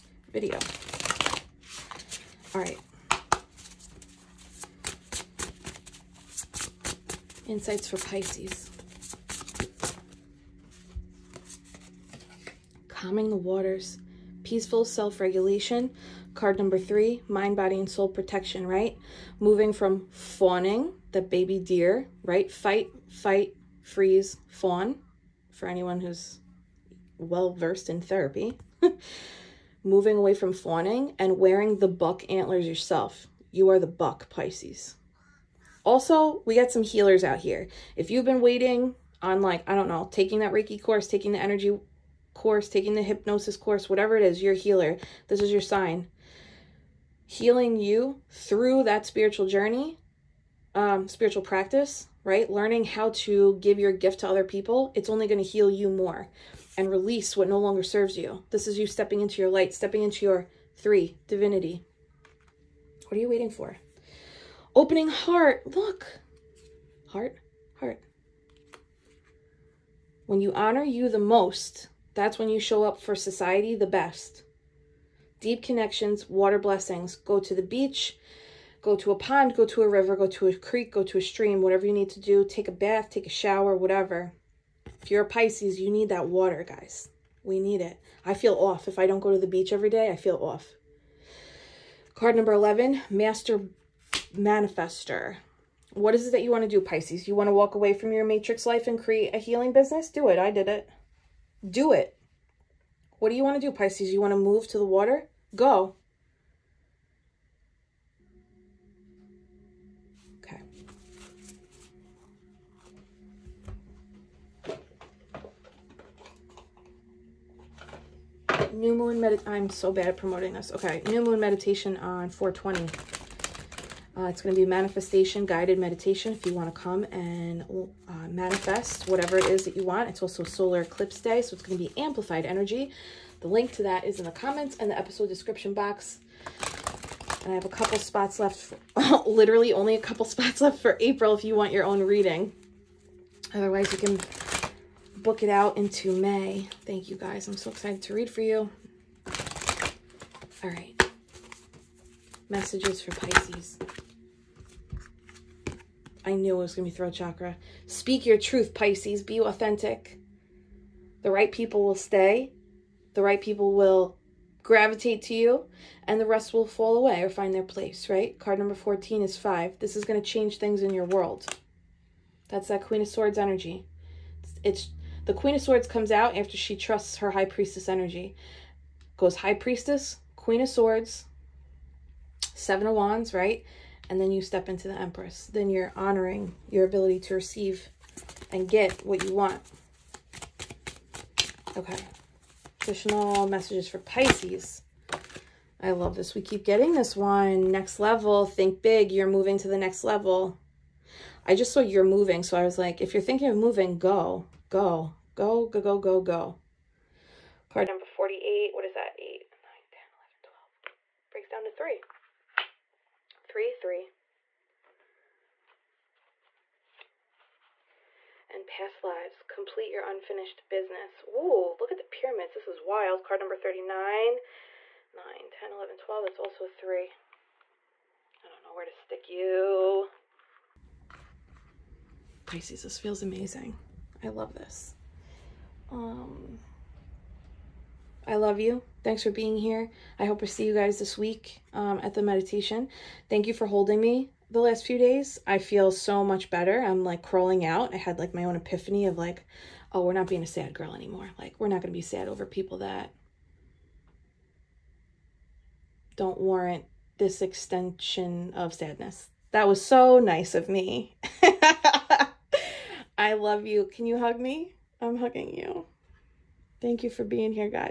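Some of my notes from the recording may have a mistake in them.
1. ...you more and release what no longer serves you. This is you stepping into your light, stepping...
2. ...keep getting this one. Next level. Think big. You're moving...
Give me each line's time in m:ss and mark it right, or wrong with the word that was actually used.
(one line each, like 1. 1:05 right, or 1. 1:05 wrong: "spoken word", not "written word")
1. 0:55 right
2. 3:16 right.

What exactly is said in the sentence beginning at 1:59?
I'm so bad at promoting this.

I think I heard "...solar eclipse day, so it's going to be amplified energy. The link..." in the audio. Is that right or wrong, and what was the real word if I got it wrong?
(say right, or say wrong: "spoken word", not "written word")
right.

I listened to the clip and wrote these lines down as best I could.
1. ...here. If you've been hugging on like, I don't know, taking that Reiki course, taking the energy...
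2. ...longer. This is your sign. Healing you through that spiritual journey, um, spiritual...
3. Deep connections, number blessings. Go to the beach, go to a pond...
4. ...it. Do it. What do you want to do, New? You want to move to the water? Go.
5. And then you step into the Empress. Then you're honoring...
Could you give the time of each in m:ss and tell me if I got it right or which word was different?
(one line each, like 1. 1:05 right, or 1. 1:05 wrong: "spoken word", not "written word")
1. 0:37 wrong: "waiting", not "hugging"
2. 0:44 wrong: "healer", not "longer"
3. 1:15 wrong: "water", not "number"
4. 1:40 wrong: "Pisces", not "New"
5. 3:04 right.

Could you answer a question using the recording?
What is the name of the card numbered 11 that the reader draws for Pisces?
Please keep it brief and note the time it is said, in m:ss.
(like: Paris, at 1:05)
Master Manifester, at 1:33.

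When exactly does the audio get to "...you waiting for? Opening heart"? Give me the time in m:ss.
1:03.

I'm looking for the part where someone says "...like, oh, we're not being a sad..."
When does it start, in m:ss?
4:09.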